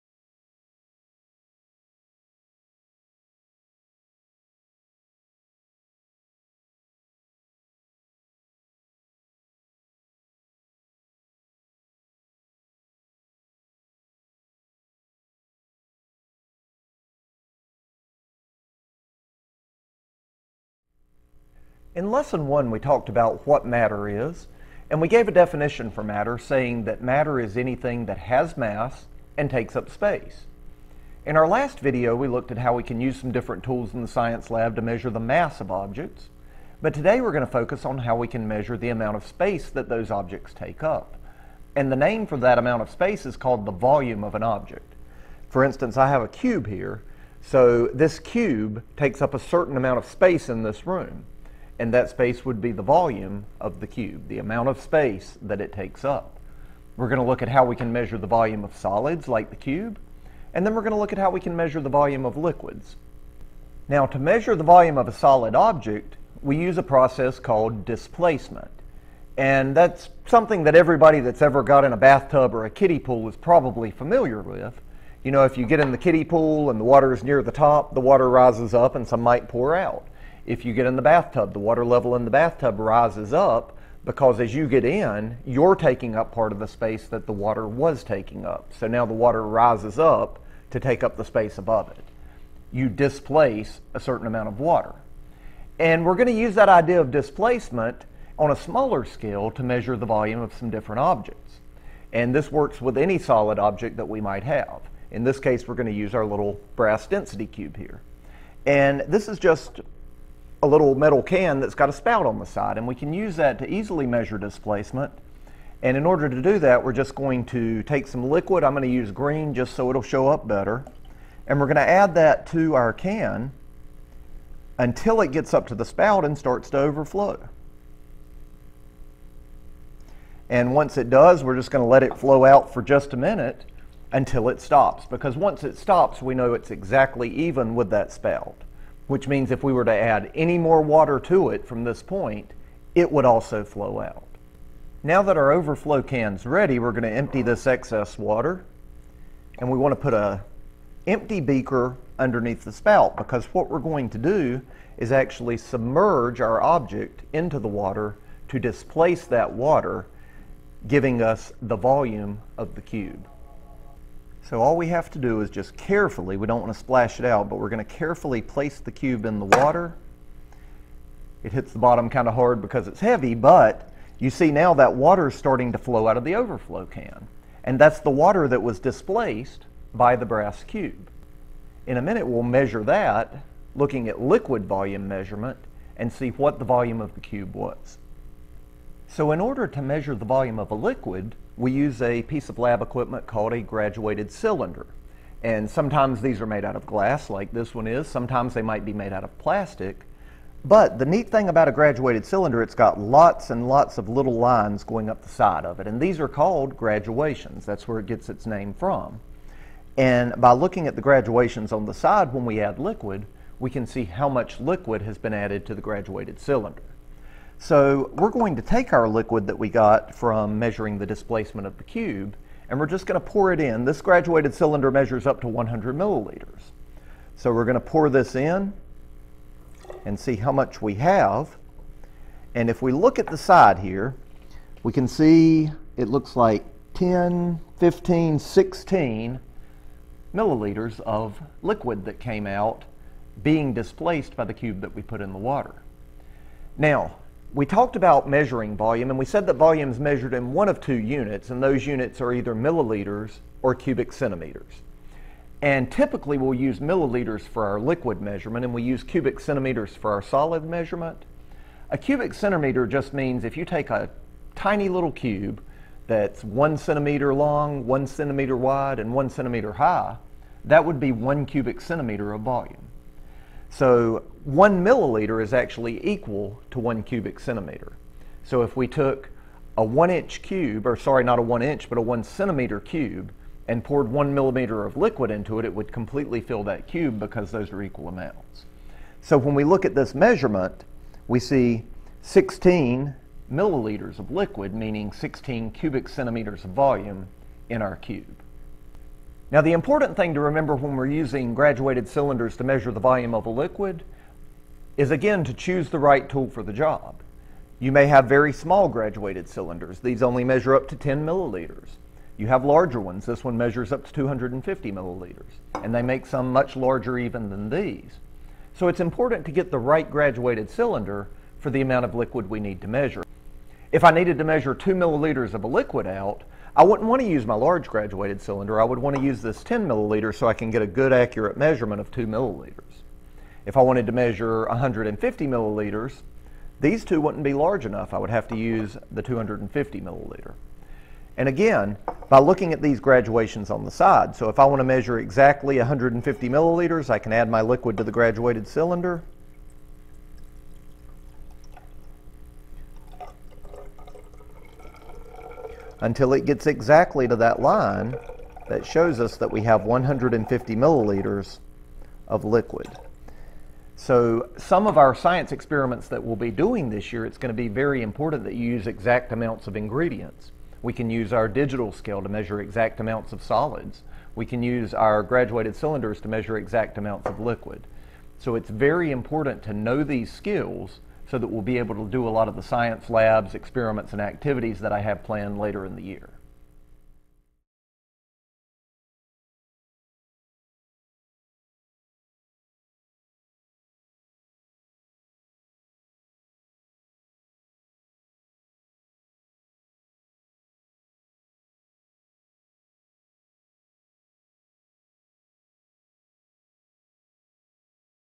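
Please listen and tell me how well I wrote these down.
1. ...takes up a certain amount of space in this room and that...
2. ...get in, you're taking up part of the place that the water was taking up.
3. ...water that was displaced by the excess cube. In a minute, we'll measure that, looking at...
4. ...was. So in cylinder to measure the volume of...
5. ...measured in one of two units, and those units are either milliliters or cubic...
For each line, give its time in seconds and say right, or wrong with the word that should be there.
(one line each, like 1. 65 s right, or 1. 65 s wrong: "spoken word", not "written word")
1. 48 s right
2. 84 s wrong: "space", not "place"
3. 178 s wrong: "brass", not "excess"
4. 187 s wrong: "order", not "cylinder"
5. 249 s right.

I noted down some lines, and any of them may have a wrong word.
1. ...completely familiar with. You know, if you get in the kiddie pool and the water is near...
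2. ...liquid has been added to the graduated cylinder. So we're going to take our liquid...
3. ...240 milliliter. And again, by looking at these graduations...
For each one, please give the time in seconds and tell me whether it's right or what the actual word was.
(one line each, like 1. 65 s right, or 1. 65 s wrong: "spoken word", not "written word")
1. 73 s wrong: "probably", not "completely"
2. 214 s right
3. 339 s wrong: "250", not "240".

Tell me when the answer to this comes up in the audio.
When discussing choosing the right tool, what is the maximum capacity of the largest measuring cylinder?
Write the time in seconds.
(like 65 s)
314 s.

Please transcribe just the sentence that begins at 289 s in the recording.
So when we look at this measurement, we see 16 milliliters of liquid, meaning 16 cubic centimeters of volume in our cube.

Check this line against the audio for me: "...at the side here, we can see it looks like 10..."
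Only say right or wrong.
right.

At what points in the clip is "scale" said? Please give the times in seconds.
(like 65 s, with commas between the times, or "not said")
99 s, 371 s.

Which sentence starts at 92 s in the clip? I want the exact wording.
You displace a certain amount of water.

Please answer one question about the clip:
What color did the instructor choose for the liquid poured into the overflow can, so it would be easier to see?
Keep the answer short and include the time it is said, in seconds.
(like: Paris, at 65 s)
Green, at 119 s.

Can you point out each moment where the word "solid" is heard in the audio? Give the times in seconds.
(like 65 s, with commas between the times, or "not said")
58 s, 65 s, 103 s, 260 s, 373 s.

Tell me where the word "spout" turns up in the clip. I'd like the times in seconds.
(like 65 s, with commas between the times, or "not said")
111 s, 125 s, 138 s, 152 s.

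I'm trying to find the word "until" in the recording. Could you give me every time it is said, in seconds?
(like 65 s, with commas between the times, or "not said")
124 s, 134 s, 356 s.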